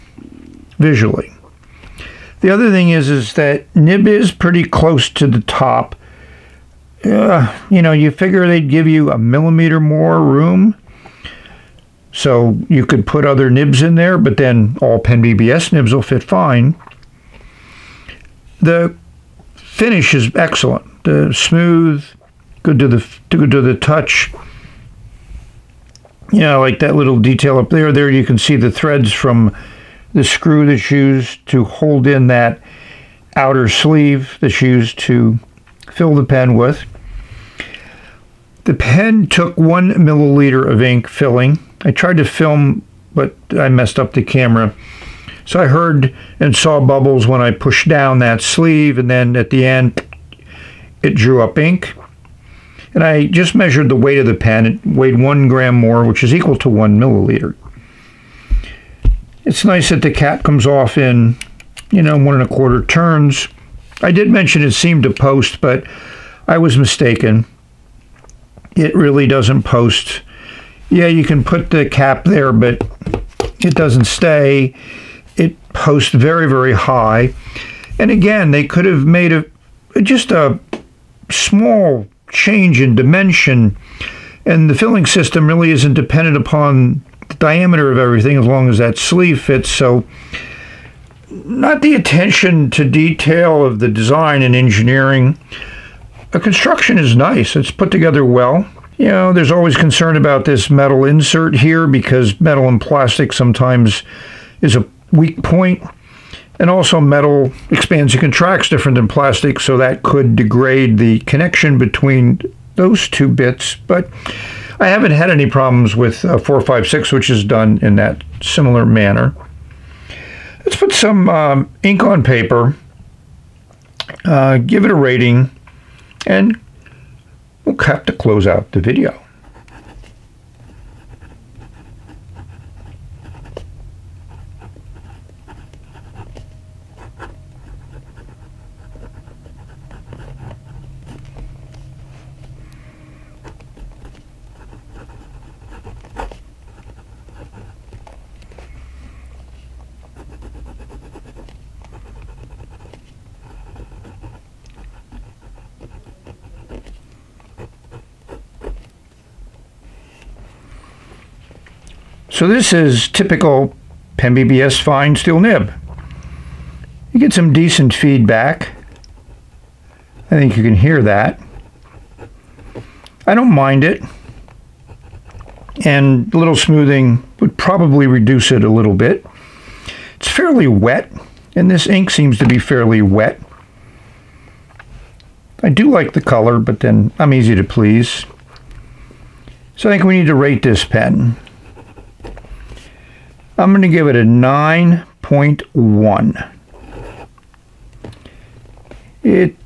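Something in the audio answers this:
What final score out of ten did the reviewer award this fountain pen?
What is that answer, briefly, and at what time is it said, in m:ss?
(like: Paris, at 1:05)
9.1, at 3:14.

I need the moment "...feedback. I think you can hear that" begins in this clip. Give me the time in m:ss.
2:47.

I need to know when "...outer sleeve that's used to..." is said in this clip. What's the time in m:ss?
0:33.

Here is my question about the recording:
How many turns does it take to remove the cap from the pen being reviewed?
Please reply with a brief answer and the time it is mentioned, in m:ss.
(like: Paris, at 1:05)
1 and a quarter, at 1:02.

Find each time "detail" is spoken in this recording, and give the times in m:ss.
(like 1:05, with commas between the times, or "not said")
0:27, 1:32.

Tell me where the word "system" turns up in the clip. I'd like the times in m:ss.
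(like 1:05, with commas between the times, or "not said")
1:25.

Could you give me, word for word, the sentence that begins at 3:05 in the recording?
I do like the color, but then I'm easy to please.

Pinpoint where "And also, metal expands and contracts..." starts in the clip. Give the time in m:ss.
1:46.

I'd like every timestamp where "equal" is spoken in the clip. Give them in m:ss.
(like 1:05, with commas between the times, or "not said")
0:56.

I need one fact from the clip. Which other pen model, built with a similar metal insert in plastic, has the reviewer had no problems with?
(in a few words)
456.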